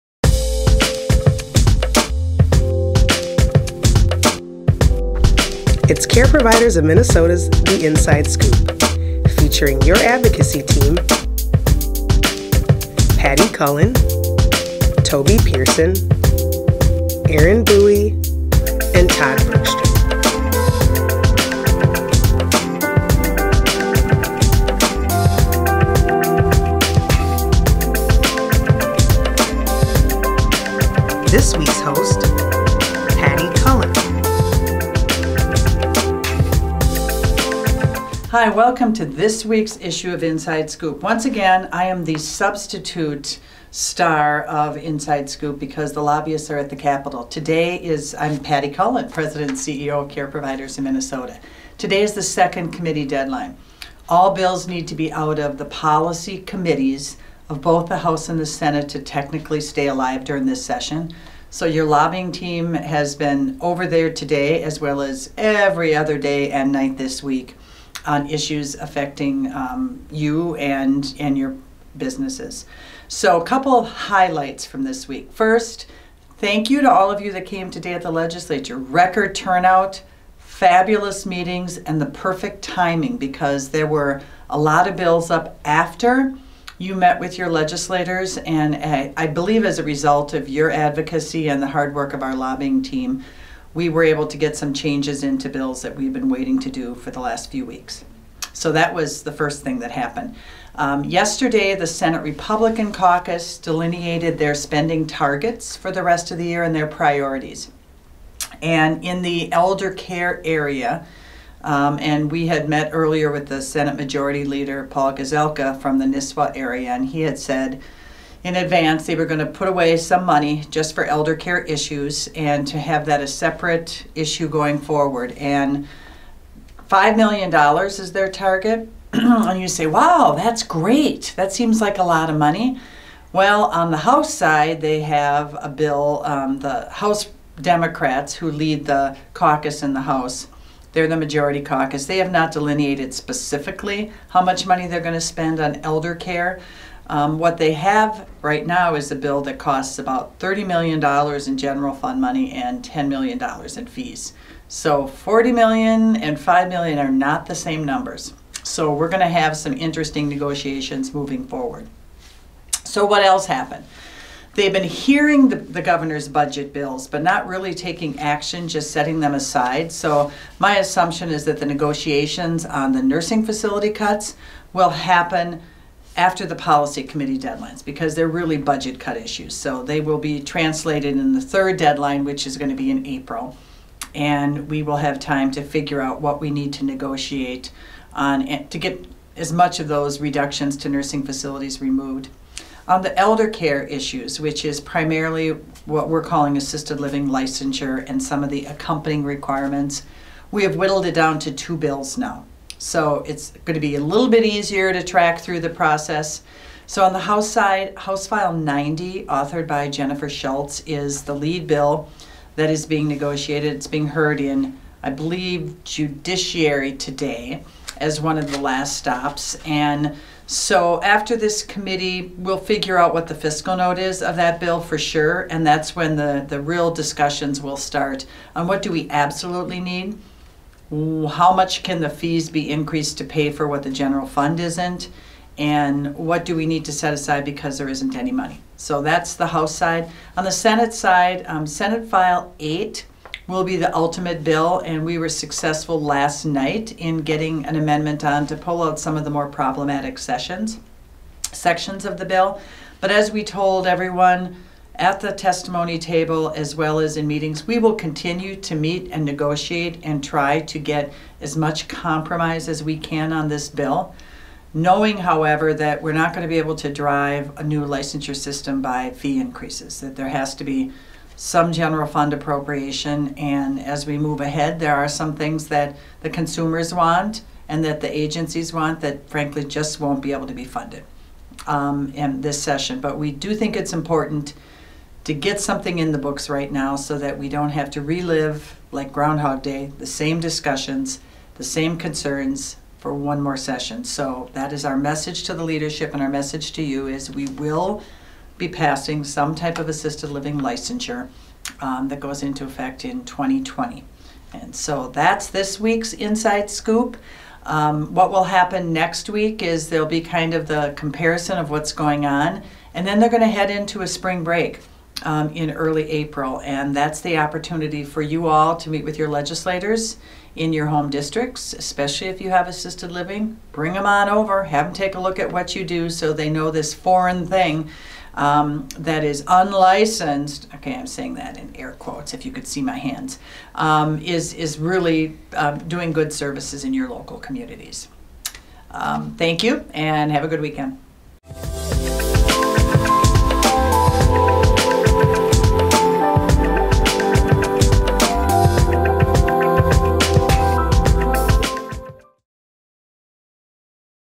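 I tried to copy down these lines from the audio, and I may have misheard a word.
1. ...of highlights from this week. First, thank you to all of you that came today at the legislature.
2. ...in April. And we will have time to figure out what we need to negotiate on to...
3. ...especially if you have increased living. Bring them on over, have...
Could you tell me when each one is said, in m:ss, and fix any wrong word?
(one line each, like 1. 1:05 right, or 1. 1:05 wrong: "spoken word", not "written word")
1. 1:13 right
2. 3:02 right
3. 5:21 wrong: "assisted", not "increased".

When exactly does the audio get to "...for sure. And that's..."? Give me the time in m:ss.
3:44.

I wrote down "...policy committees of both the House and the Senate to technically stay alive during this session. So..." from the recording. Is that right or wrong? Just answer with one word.
right.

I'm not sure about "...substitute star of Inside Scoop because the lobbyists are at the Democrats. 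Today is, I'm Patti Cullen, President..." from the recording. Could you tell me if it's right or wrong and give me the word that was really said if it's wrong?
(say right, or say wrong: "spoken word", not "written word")
wrong: "Capitol", not "Democrats".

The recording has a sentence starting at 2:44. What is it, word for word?
They've been hearing the, the, governor's budget bills, but not really taking action, just setting them aside.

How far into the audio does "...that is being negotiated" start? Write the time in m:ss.
3:32.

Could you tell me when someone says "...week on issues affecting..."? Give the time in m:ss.
1:07.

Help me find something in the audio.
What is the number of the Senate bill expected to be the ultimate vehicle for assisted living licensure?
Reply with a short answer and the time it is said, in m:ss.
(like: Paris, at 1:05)
Senate File 8, at 4:01.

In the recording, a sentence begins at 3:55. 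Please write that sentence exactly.
And what do we need to set aside because there isn't any money?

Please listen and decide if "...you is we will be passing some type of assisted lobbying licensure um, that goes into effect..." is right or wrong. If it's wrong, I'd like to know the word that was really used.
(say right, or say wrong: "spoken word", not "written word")
wrong: "living", not "lobbying".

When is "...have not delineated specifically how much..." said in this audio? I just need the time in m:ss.
2:22.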